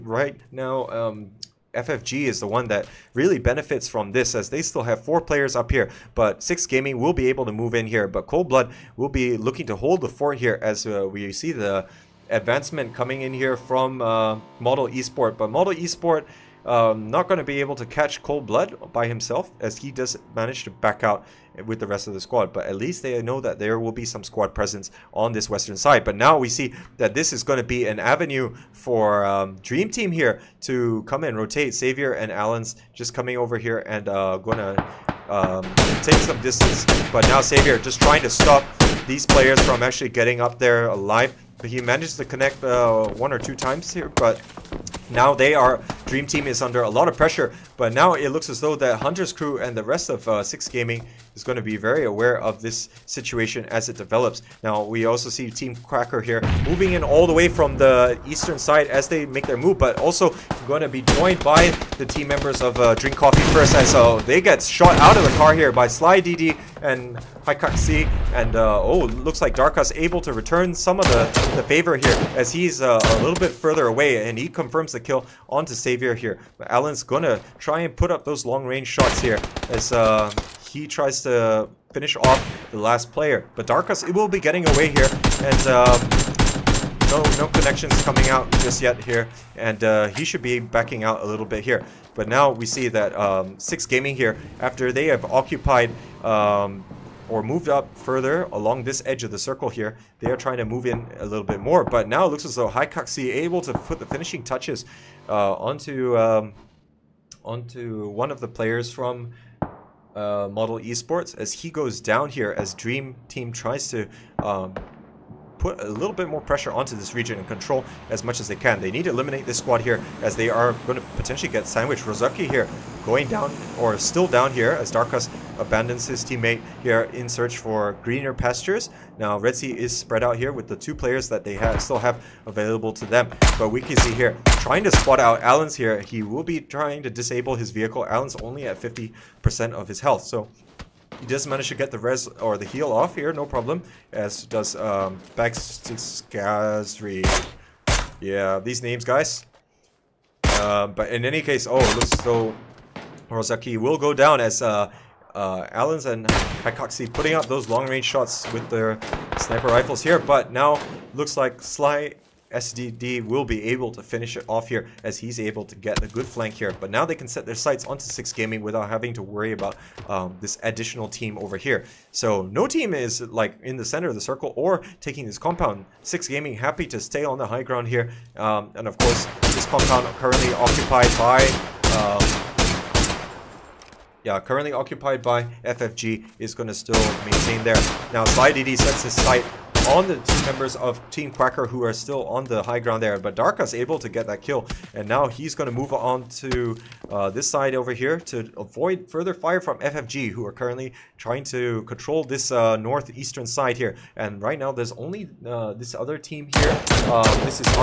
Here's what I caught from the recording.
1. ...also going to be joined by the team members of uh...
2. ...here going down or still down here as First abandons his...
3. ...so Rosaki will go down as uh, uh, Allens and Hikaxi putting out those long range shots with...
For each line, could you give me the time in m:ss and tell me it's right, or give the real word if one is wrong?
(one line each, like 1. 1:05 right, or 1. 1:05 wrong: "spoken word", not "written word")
1. 0:59 right
2. 2:02 wrong: "Darkus", not "First"
3. 2:32 right.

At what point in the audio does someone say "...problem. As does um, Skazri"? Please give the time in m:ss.
2:23.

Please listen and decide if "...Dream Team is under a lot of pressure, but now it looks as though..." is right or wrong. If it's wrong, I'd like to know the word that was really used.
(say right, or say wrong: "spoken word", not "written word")
right.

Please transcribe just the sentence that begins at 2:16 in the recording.
He will be trying to disable his vehicle.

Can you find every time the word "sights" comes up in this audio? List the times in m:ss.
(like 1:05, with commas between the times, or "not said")
2:47, 3:09.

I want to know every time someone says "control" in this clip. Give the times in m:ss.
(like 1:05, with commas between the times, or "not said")
1:57, 3:21.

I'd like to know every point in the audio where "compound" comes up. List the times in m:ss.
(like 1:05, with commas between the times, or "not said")
2:55, 2:59.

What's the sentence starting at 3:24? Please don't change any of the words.
And right now there's only uh, this other team here.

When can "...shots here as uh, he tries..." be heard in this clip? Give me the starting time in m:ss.
1:18.